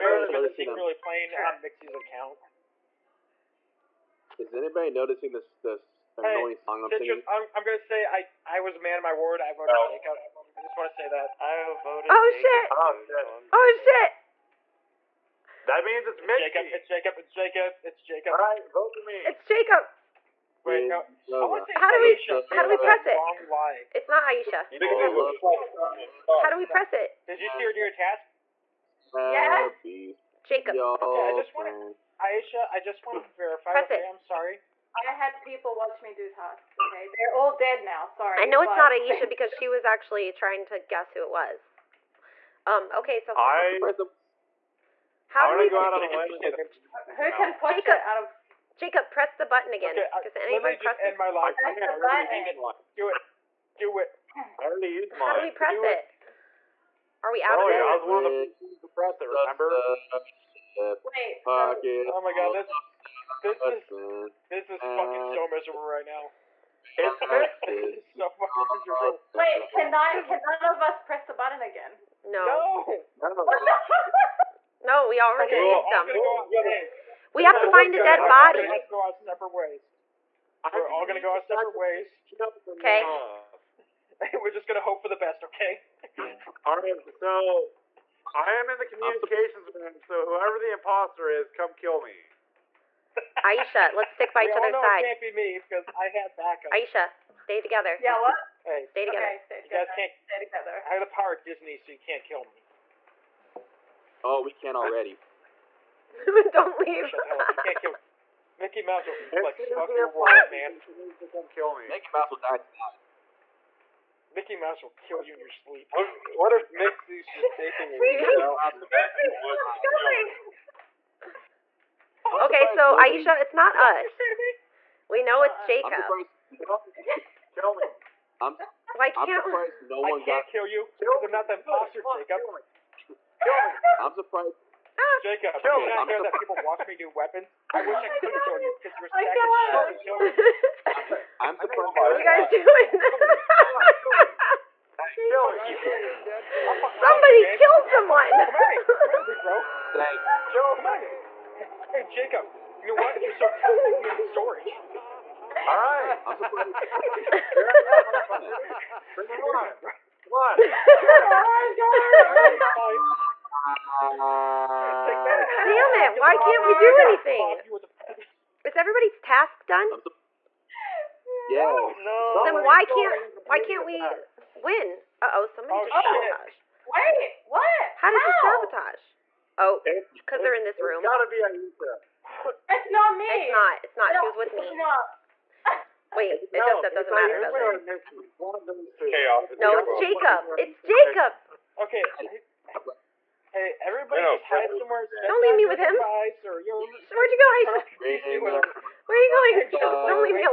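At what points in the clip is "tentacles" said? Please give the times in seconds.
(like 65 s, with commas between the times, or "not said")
not said.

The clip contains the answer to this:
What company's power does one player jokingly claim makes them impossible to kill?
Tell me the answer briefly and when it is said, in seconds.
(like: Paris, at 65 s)
Disney, at 101 s.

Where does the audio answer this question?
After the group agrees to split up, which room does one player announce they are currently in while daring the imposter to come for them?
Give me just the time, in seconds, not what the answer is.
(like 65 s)
88 s.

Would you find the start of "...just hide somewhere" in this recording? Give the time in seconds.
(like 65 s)
194 s.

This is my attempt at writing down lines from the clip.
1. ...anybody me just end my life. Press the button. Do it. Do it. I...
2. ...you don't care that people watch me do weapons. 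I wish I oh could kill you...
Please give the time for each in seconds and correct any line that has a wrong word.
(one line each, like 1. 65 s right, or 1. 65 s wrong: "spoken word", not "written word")
1. 50 s right
2. 135 s right.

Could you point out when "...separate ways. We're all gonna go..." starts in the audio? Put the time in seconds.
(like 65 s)
79 s.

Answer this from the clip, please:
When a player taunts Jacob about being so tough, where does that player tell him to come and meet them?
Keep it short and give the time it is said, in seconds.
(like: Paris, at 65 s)
Storage, at 154 s.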